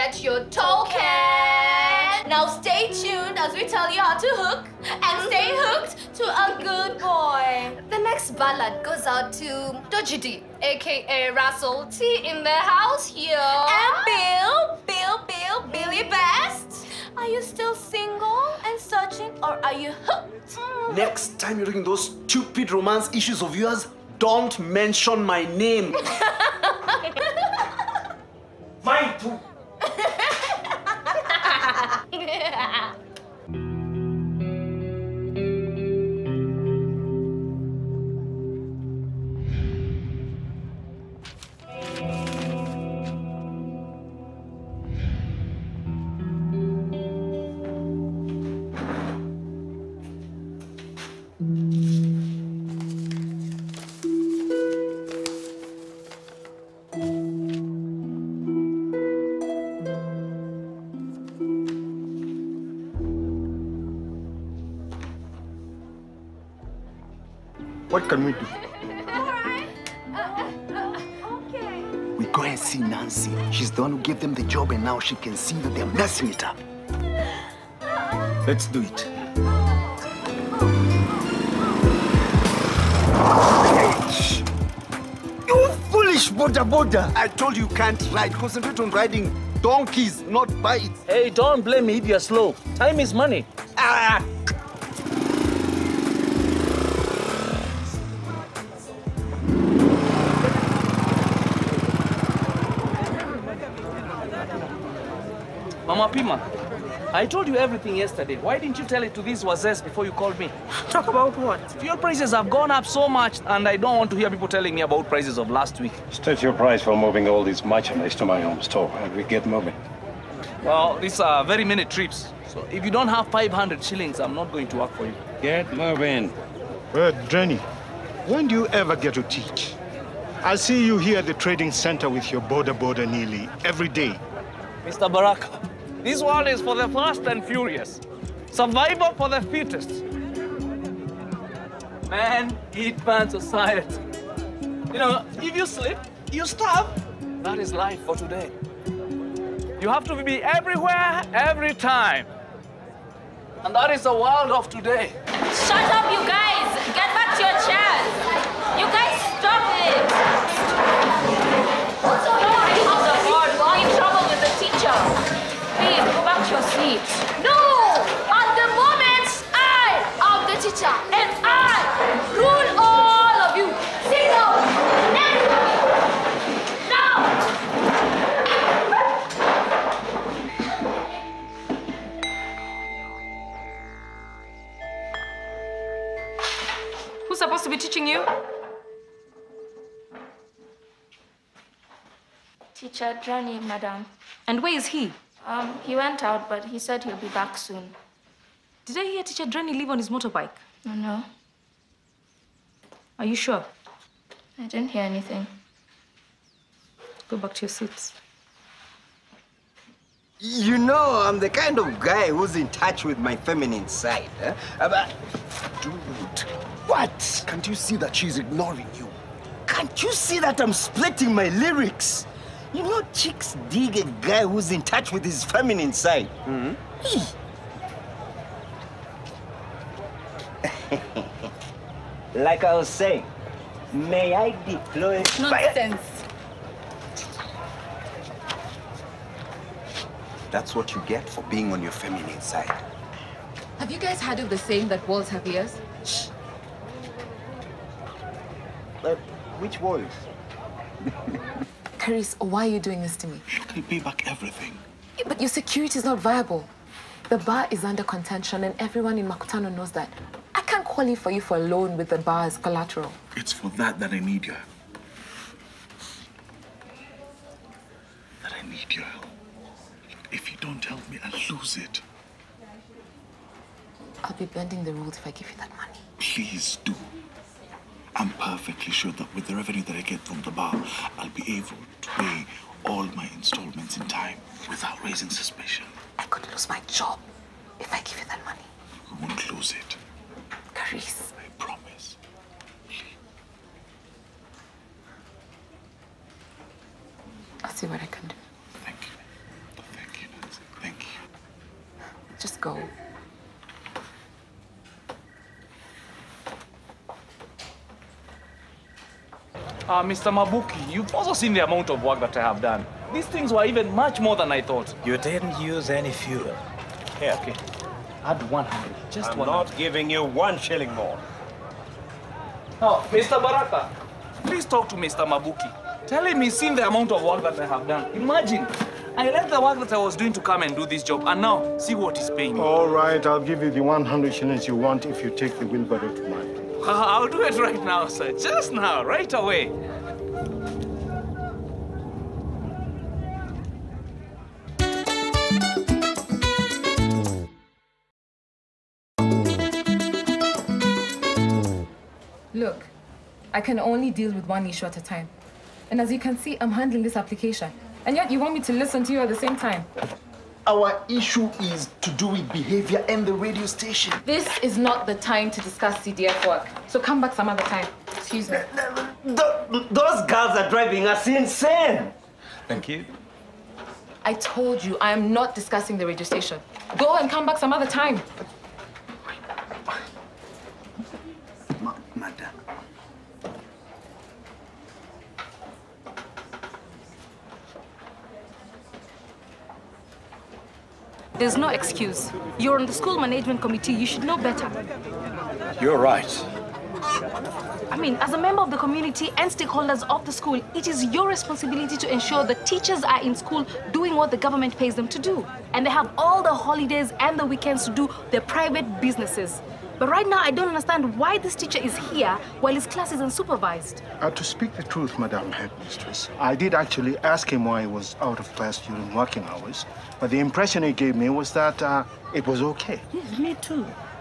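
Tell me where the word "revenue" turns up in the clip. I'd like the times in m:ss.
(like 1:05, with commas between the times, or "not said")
4:39.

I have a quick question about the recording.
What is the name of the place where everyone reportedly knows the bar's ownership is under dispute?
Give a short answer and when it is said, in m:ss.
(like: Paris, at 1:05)
Makutano, at 4:19.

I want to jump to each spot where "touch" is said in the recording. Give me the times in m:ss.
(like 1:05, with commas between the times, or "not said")
3:32, 3:44.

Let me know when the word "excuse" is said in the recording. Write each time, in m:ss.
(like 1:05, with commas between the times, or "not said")
6:08, 6:31.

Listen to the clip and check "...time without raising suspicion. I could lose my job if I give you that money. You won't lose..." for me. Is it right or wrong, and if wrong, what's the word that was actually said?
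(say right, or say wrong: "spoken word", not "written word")
right.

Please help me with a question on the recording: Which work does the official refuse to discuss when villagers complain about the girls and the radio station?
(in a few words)
CDF work.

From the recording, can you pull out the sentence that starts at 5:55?
And as you can see, I'm handling this application.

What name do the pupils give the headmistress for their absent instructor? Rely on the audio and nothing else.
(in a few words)
Teacher Drani.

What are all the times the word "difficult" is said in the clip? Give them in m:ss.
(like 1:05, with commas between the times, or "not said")
not said.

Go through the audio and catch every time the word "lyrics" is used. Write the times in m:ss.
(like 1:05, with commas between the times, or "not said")
3:41.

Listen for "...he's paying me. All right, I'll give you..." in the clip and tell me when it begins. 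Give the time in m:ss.
5:32.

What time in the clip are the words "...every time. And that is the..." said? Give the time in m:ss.
2:31.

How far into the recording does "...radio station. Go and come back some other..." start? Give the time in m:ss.
6:16.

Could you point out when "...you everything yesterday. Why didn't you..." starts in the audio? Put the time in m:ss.
1:47.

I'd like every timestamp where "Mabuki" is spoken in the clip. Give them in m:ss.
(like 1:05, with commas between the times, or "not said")
5:10, 5:25.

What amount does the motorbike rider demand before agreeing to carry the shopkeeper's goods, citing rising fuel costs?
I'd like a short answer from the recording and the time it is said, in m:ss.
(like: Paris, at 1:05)
500 shillings, at 2:03.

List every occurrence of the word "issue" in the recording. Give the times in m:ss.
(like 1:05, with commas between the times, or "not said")
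0:23, 5:54, 6:01.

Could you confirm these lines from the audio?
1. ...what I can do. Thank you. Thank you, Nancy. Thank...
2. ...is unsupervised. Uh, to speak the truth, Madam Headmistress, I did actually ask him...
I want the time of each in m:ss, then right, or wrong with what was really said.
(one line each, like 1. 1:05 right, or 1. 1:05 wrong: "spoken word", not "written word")
1. 4:57 right
2. 6:53 right.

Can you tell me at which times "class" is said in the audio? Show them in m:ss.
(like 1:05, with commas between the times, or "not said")
6:52, 6:58.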